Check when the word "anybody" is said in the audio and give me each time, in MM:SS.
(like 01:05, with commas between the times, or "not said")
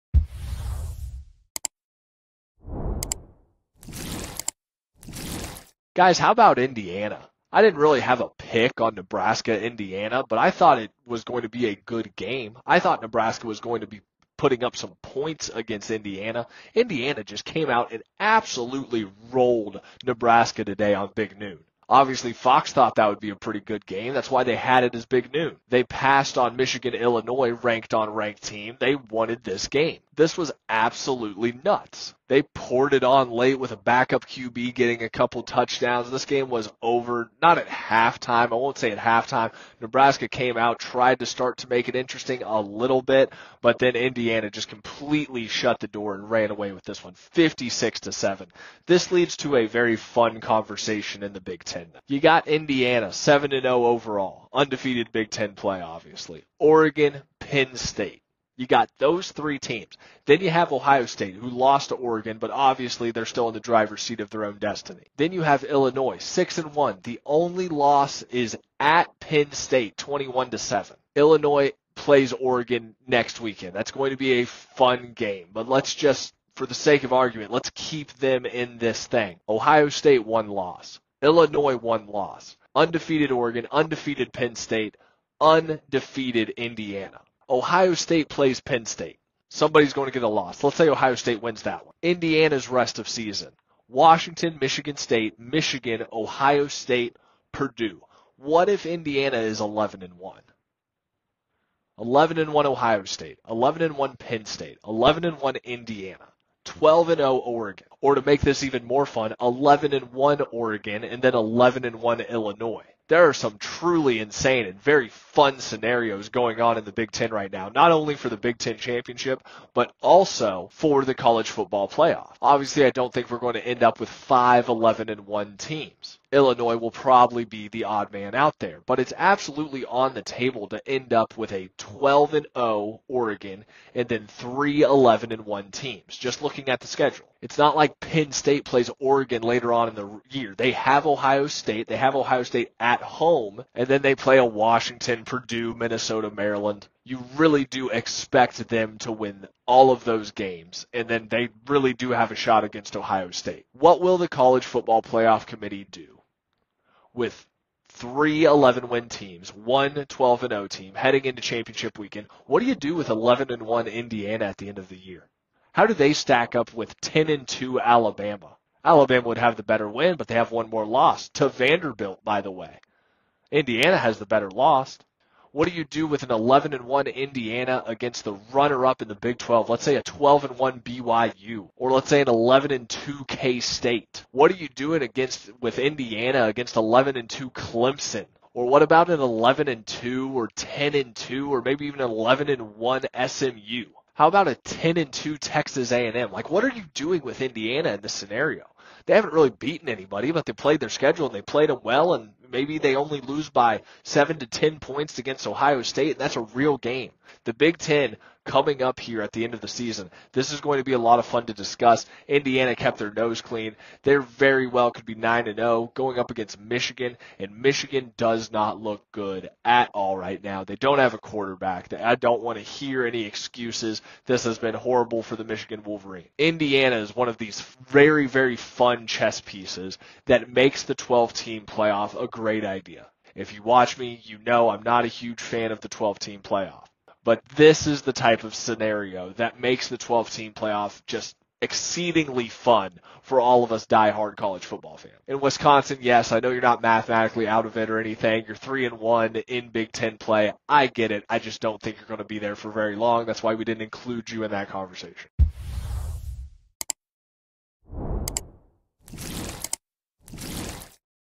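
03:19.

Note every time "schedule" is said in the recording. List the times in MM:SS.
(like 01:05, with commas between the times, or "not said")
02:16, 03:20.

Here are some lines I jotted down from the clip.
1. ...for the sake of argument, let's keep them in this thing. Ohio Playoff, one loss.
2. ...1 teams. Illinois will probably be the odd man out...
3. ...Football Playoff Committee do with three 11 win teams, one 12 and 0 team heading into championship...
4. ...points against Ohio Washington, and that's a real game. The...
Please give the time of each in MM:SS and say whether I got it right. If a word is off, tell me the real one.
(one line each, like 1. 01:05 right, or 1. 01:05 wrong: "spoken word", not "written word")
1. 01:16 wrong: "State", not "Playoff"
2. 02:05 right
3. 02:34 right
4. 03:24 wrong: "State", not "Washington".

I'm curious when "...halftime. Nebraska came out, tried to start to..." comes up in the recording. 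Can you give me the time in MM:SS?
00:38.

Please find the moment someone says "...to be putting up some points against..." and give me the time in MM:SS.
00:13.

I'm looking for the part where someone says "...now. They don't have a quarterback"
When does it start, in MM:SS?
03:40.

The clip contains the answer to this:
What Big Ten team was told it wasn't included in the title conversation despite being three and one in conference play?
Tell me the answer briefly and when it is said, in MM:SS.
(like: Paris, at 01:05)
Wisconsin, at 04:05.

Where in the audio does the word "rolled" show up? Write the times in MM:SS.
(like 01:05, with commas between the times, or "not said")
00:19.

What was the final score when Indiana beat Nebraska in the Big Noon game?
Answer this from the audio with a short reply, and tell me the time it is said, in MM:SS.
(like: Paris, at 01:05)
56-7, at 00:47.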